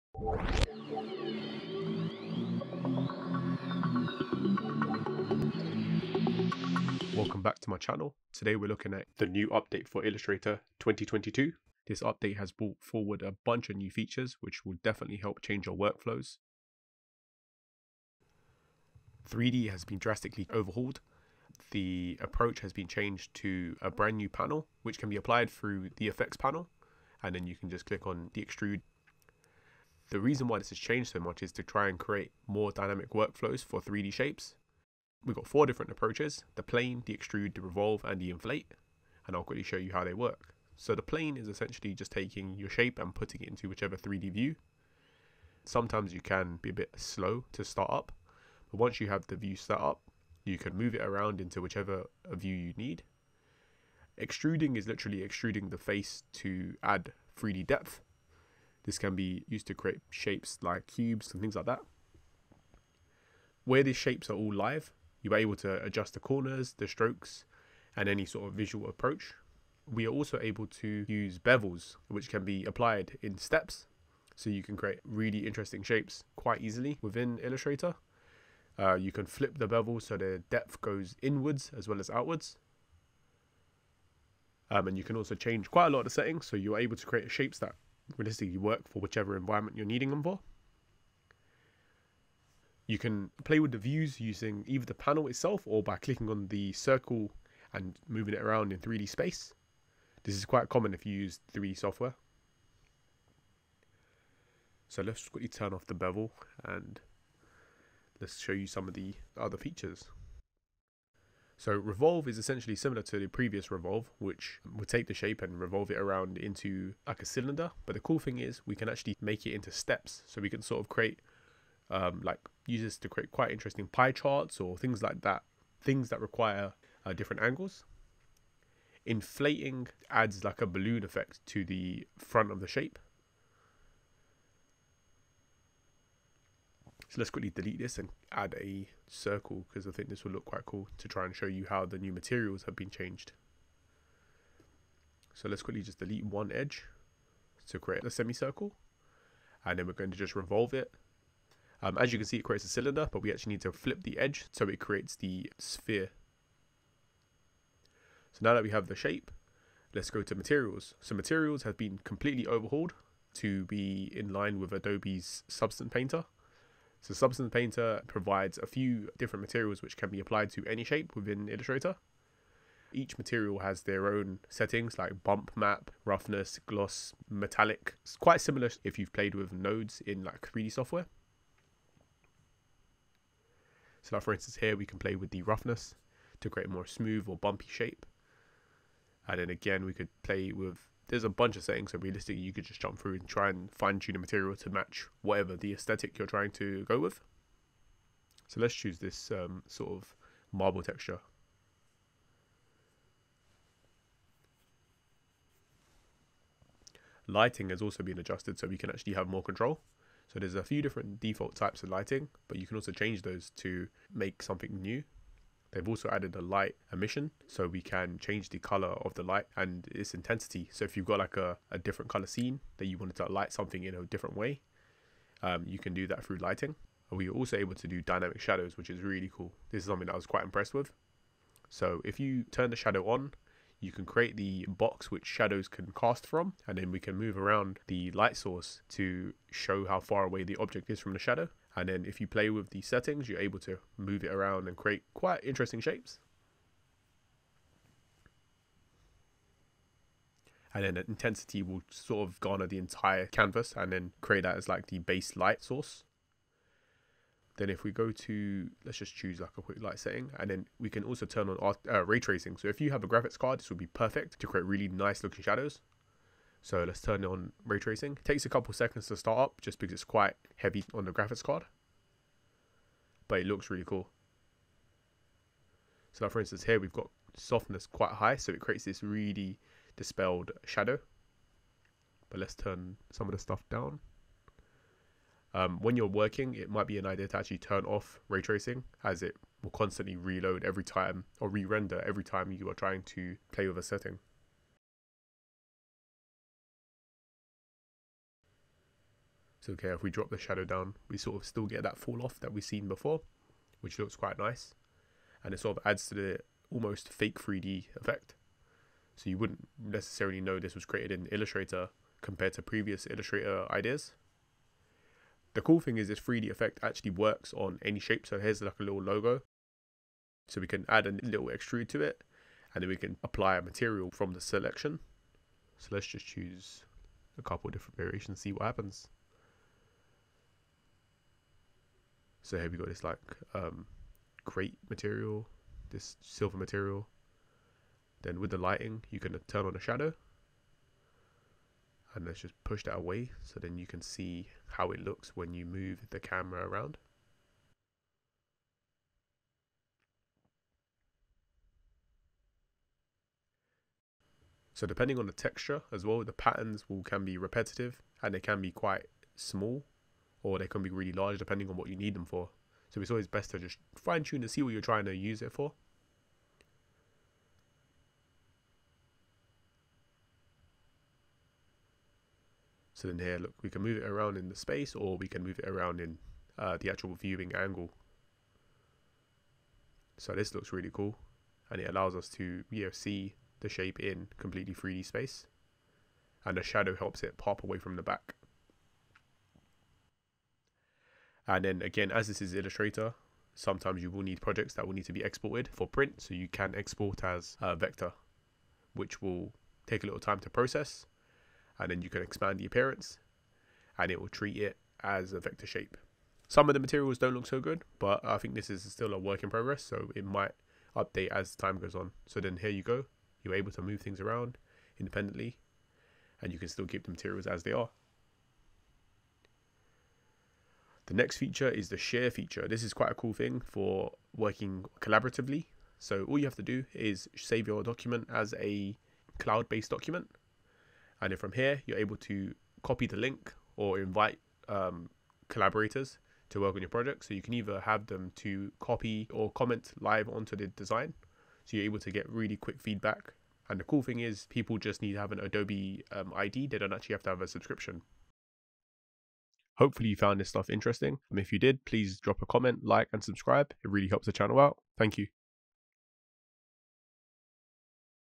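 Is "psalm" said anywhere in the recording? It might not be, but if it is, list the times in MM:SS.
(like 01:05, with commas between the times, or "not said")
not said.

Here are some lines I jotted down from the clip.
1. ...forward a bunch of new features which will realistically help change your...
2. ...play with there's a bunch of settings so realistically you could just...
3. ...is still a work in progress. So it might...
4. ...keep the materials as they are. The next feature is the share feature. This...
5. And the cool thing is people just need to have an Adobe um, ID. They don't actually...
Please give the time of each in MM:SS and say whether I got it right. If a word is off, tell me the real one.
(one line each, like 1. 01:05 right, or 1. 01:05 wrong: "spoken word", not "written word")
1. 00:12 wrong: "definitely", not "realistically"
2. 03:10 right
3. 06:48 right
4. 06:56 right
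5. 07:23 right.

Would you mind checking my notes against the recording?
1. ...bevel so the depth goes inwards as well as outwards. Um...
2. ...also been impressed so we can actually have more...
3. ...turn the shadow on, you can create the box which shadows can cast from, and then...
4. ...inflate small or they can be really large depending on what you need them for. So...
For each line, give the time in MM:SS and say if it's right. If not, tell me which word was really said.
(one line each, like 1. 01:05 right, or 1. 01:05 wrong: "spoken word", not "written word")
1. 01:19 right
2. 03:27 wrong: "adjusted", not "impressed"
3. 03:52 right
4. 05:58 wrong: "quite", not "inflate".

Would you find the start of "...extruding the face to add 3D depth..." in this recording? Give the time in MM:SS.
00:55.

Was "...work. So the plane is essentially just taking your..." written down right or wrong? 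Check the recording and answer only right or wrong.
right.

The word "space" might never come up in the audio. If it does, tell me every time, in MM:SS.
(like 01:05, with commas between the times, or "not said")
01:39, 06:14, 06:25.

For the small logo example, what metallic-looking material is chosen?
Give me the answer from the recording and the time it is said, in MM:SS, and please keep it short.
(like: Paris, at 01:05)
Silver, at 05:36.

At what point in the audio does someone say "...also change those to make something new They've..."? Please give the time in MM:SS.
03:32.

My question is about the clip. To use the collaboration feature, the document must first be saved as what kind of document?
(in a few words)
Cloud-based document.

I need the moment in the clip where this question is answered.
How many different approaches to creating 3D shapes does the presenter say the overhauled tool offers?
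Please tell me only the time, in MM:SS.
00:35.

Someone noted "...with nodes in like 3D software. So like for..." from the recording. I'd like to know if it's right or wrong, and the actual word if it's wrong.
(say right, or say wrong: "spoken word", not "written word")
right.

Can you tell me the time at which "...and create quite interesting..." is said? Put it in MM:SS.
04:04.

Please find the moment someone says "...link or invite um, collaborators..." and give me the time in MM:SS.
07:13.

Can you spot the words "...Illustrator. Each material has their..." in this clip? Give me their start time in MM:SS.
02:51.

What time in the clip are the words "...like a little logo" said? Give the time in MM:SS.
05:18.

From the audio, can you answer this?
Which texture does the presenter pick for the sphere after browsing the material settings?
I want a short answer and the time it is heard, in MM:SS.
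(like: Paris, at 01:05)
Marble, at 03:20.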